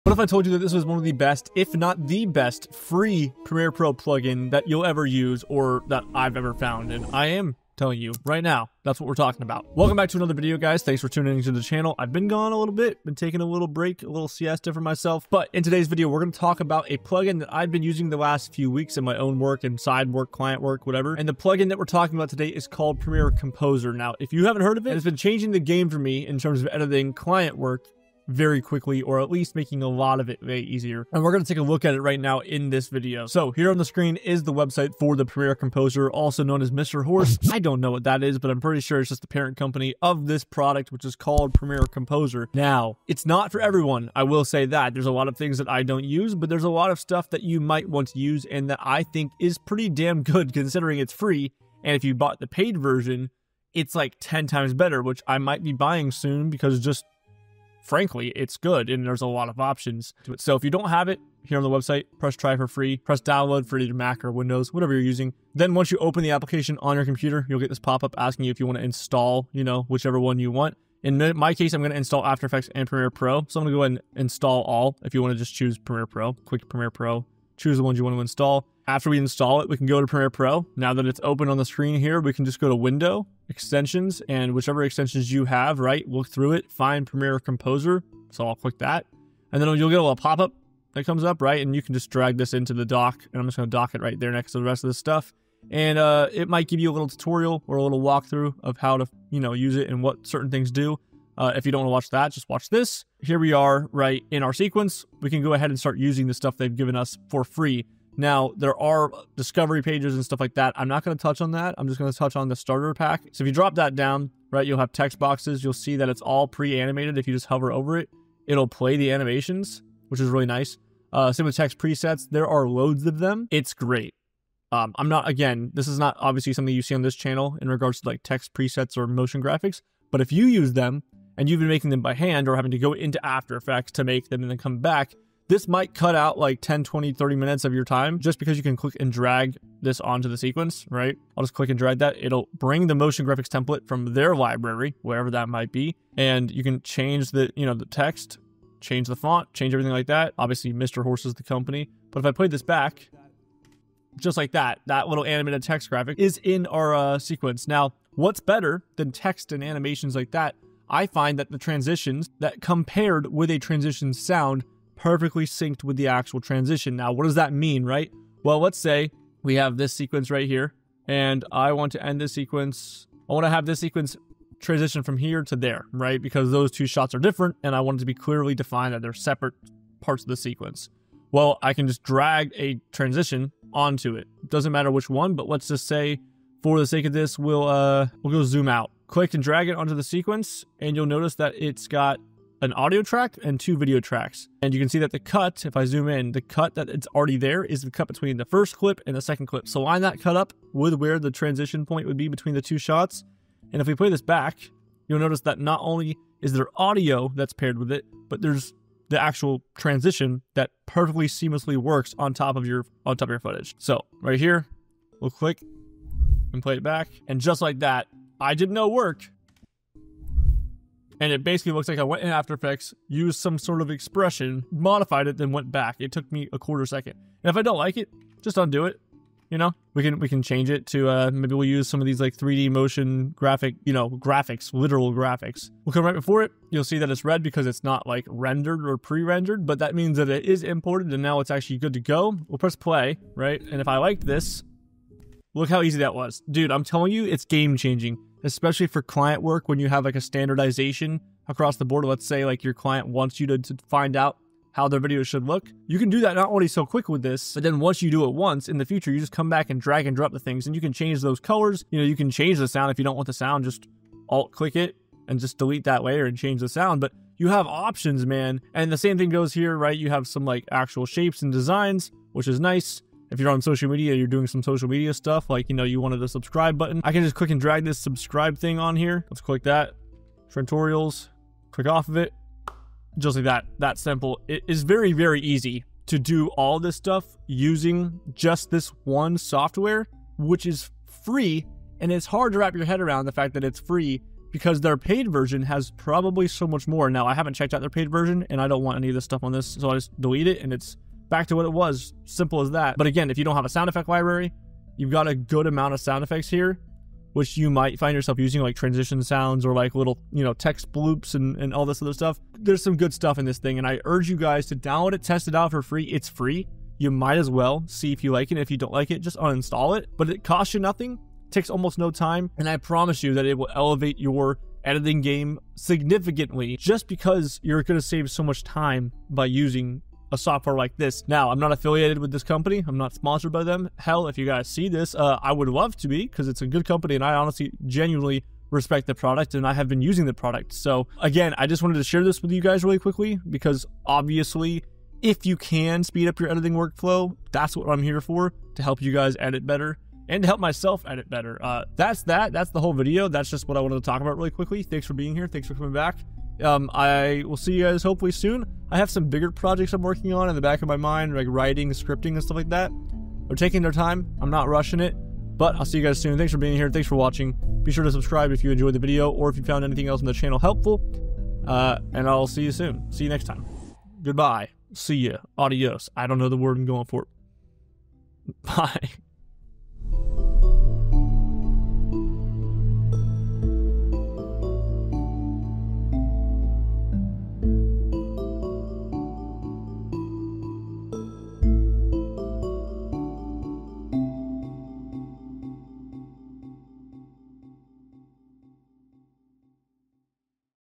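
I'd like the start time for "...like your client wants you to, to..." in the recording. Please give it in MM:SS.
04:12.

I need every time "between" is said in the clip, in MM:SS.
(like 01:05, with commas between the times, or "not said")
03:18, 03:22.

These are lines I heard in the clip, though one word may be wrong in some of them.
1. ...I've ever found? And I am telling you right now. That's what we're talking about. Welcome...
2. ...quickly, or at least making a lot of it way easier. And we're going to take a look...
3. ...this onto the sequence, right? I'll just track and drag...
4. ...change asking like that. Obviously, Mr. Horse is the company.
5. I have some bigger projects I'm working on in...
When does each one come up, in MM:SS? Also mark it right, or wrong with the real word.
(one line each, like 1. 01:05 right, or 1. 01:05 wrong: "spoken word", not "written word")
1. 00:06 right
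2. 00:28 right
3. 02:19 wrong: "click", not "track"
4. 02:29 wrong: "everything", not "asking"
5. 05:58 right.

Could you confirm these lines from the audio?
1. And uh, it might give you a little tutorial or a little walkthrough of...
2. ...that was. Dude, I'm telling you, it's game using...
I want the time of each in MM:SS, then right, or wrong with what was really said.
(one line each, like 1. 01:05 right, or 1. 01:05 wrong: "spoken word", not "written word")
1. 01:35 right
2. 04:05 wrong: "changing", not "using".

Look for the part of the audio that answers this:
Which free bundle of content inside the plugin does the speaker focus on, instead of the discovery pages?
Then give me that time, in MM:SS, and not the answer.
01:52.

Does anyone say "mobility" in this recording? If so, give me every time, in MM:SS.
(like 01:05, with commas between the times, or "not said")
not said.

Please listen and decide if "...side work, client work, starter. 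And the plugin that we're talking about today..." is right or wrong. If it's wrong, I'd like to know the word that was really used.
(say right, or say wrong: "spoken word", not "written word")
wrong: "whatever", not "starter".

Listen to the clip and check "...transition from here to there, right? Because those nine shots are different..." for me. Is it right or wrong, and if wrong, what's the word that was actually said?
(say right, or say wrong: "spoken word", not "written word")
wrong: "two", not "nine".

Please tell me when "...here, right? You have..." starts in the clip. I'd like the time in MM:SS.
04:29.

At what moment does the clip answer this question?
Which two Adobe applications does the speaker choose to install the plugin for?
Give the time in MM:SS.
01:12.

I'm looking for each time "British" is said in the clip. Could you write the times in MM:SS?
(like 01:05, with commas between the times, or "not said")
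not said.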